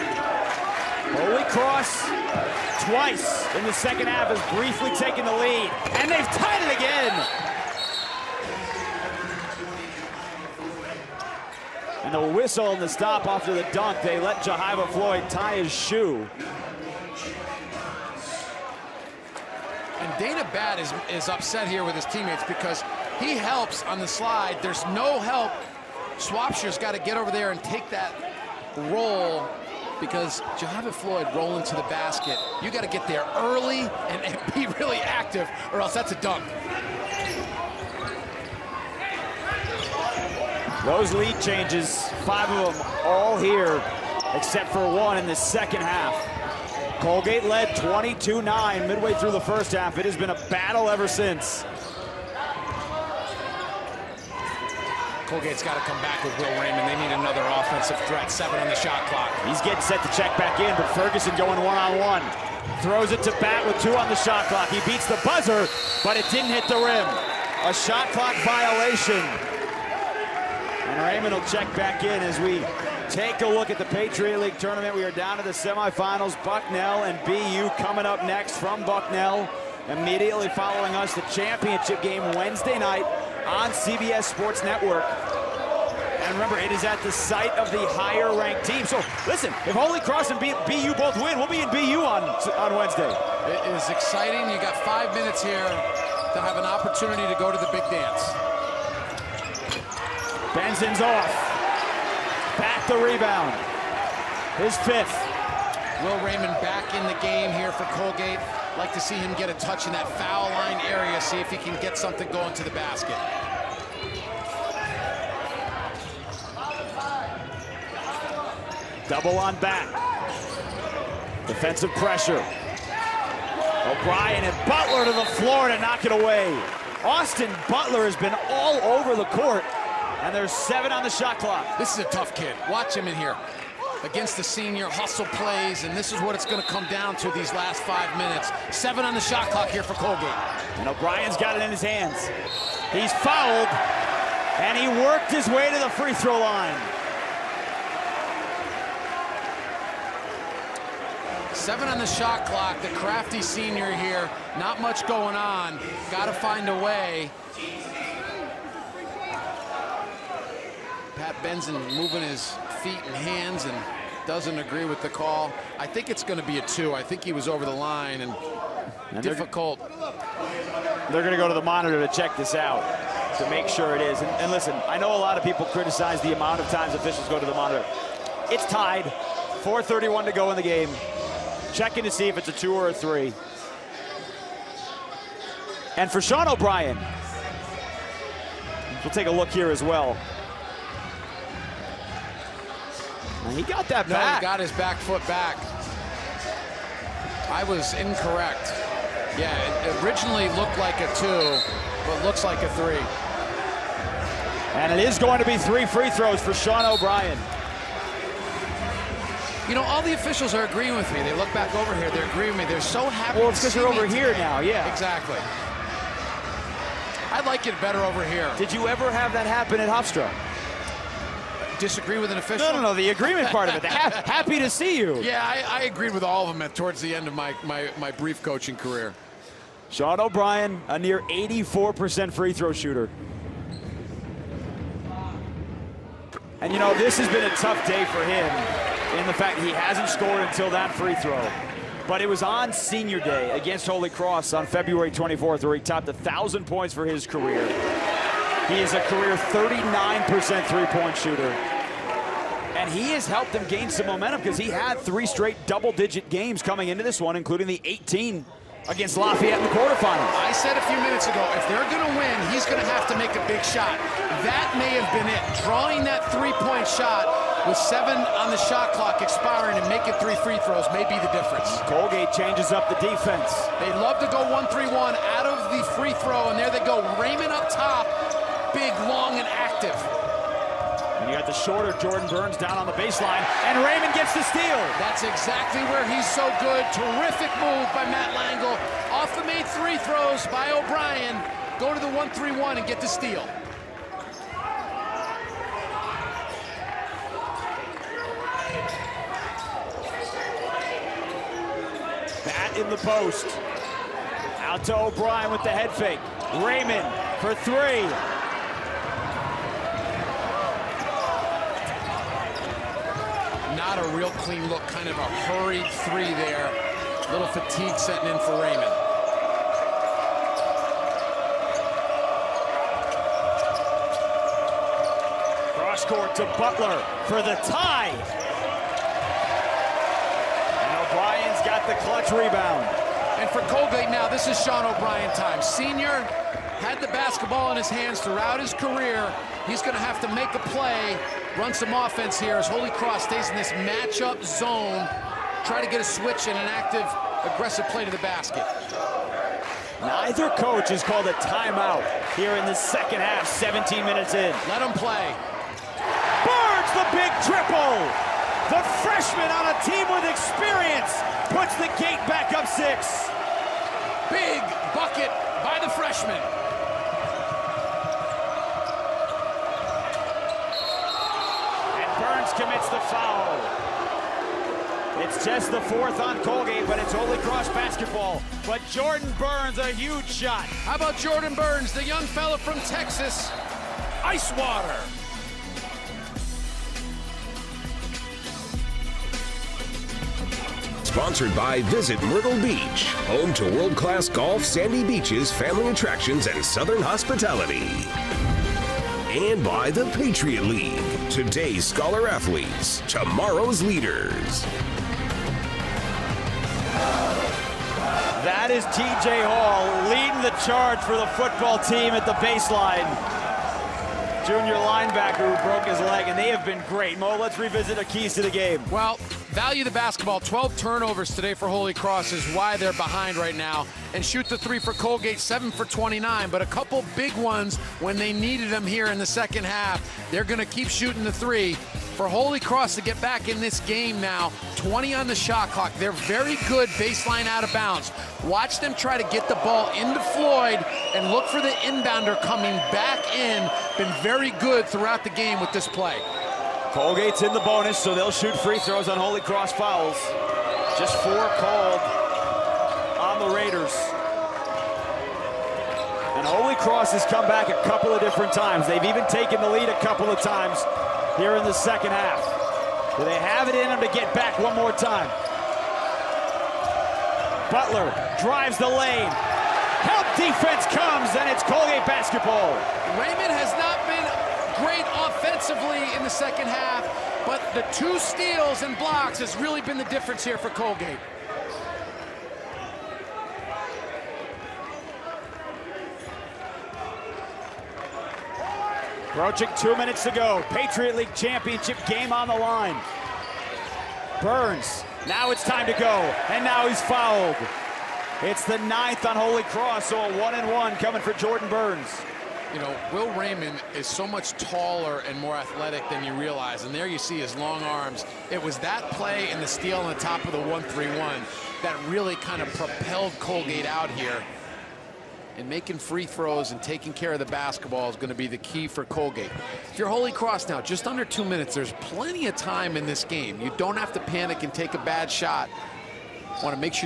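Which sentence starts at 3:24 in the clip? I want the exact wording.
And it is going to be three free throws for Sean O'Brien.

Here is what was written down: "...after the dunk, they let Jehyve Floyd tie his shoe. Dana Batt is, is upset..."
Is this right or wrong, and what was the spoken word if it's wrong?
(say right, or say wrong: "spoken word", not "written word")
right.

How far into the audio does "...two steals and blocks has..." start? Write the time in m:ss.
7:57.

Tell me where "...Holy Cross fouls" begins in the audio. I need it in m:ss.
7:29.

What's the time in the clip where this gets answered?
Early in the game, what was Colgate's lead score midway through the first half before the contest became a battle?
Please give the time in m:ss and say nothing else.
0:47.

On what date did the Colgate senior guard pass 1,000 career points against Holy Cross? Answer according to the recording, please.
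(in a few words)
February 24th.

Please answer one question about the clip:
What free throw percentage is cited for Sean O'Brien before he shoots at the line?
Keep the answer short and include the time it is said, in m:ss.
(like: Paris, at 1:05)
84%, at 3:51.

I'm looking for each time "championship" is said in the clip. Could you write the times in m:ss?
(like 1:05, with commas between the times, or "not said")
1:21, 8:11.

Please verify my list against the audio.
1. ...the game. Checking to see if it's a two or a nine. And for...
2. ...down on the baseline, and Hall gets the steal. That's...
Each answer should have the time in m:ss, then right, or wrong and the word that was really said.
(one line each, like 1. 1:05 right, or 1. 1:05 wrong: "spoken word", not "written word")
1. 3:00 wrong: "three", not "nine"
2. 4:42 wrong: "Rayman", not "Hall".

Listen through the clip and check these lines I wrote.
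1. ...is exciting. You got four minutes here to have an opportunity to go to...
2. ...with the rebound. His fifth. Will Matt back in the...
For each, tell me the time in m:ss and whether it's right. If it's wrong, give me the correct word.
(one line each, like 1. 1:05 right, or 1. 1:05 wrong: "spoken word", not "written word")
1. 1:33 wrong: "five", not "four"
2. 1:42 wrong: "Rayman", not "Matt".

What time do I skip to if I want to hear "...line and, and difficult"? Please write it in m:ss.
2:47.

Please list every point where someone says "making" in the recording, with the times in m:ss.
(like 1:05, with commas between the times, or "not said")
4:29, 8:35.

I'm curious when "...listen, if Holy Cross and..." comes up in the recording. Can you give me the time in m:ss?
1:29.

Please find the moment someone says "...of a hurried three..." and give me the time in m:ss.
5:15.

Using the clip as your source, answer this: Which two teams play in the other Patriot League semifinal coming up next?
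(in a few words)
Bucknell and BU.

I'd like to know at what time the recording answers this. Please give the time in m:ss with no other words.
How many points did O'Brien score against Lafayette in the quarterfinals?
4:17.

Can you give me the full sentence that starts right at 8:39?
If you're Holy Cross now, just under two minutes, there's plenty of time in this game.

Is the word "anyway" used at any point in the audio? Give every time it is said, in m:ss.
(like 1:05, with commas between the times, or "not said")
not said.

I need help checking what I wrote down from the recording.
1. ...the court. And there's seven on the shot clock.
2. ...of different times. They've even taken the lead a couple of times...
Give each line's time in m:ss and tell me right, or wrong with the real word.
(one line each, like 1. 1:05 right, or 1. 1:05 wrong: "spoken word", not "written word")
1. 2:09 right
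2. 7:38 right.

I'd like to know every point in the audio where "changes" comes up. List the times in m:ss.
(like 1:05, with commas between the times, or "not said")
0:41, 4:32.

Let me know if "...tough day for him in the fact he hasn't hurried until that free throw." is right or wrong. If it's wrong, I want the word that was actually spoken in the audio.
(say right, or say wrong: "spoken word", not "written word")
wrong: "scored", not "hurried".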